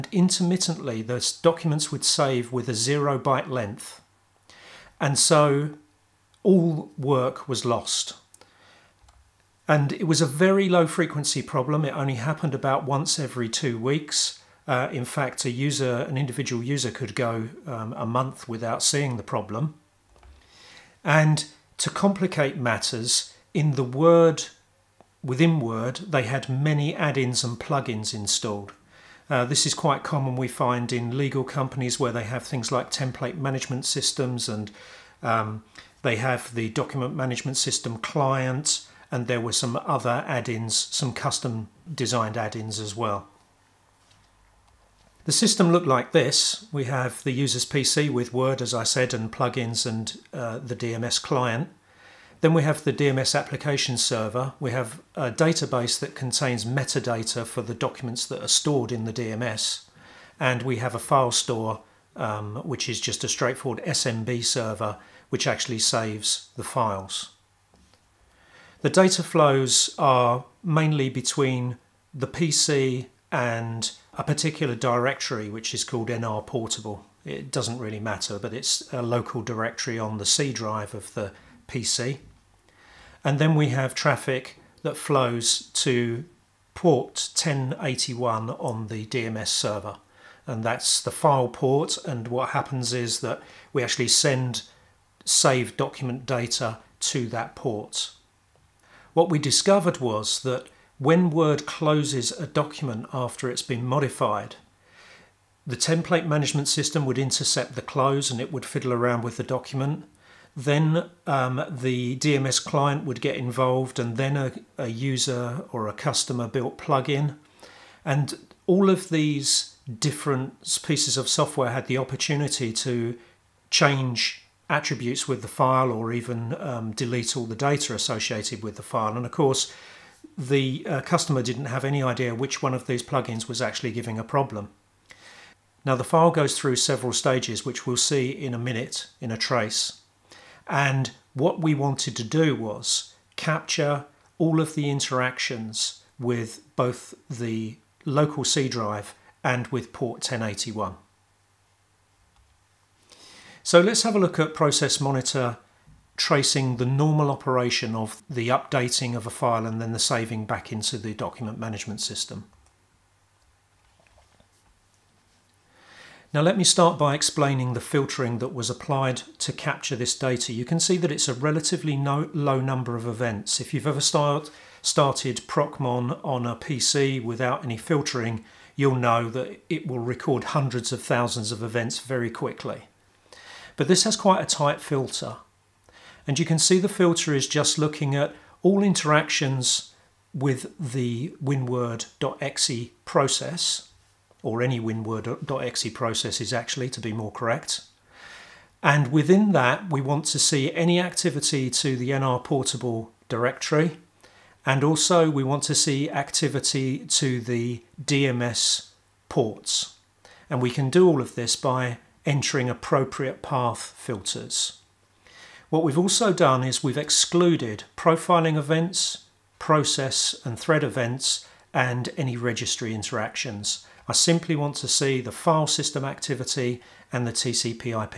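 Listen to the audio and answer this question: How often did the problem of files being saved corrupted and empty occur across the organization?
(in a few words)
once every two weeks.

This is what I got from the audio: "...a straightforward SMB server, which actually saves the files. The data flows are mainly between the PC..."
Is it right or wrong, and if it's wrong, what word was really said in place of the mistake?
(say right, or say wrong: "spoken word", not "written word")
right.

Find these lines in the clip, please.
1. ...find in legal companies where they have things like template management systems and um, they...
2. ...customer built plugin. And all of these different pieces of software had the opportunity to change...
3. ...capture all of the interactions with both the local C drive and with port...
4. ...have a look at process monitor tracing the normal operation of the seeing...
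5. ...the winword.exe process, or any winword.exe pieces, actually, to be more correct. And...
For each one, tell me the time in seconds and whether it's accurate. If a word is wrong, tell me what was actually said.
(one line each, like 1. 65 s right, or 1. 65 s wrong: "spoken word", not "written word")
1. 30 s right
2. 115 s right
3. 143 s right
4. 154 s wrong: "updating", not "seeing"
5. 190 s wrong: "processes", not "pieces".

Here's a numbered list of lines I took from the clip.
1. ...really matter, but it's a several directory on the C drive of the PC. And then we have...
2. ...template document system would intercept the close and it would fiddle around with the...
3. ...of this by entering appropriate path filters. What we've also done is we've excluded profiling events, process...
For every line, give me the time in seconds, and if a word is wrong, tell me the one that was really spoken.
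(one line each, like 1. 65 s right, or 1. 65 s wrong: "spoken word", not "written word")
1. 77 s wrong: "local", not "several"
2. 105 s wrong: "management", not "document"
3. 211 s right.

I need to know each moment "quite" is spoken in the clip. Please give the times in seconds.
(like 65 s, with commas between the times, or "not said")
29 s, 184 s.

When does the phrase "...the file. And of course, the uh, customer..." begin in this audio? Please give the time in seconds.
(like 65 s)
128 s.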